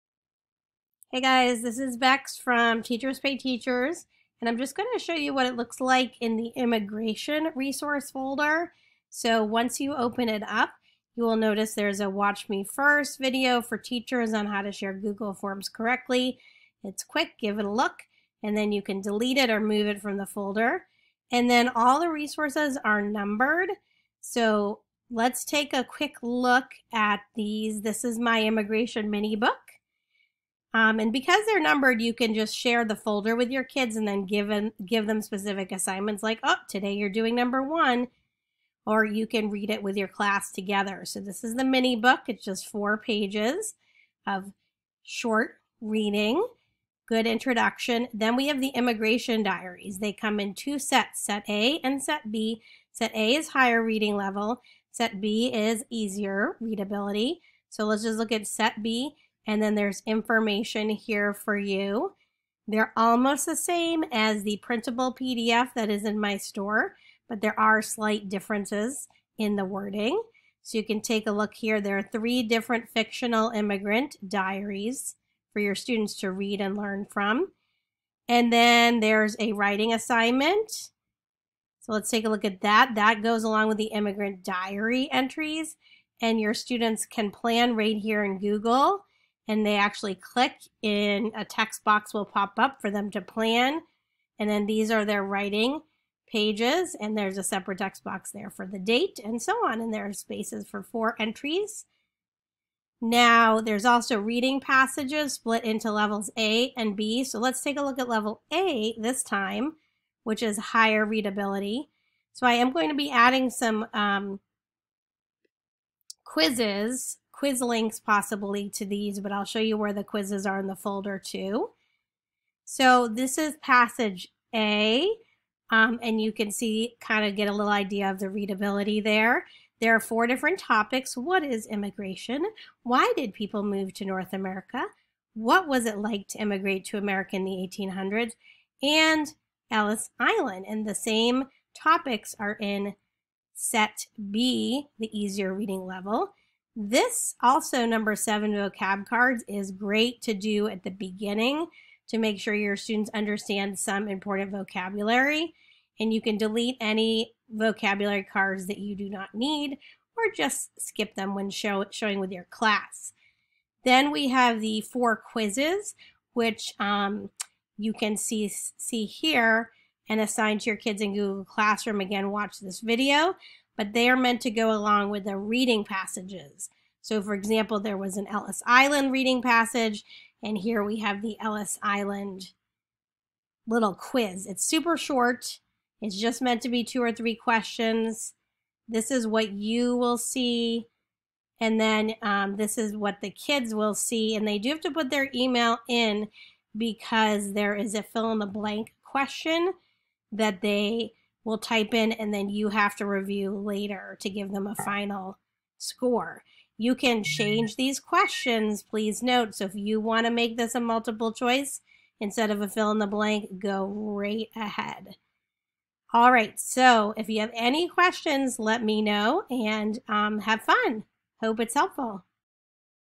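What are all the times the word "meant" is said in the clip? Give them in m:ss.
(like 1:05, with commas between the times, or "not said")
2:54, 3:06.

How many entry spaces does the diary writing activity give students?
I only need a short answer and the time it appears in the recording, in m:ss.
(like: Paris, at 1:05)
4, at 1:40.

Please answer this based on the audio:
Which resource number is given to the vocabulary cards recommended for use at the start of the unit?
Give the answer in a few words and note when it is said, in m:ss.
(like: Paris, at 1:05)
7, at 2:28.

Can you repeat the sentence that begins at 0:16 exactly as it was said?
It's quick, give it a look, and then you can delete it or move it from the folder.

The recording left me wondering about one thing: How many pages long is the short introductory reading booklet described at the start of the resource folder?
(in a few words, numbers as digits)
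4.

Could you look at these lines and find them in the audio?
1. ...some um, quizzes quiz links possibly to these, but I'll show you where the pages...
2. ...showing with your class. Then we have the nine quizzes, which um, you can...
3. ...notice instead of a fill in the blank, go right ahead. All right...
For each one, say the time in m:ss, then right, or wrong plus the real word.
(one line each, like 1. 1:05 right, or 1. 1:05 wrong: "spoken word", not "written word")
1. 1:53 wrong: "quizzes", not "pages"
2. 2:41 wrong: "four", not "nine"
3. 3:31 wrong: "choice", not "notice".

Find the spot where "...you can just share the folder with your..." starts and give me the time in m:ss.
0:32.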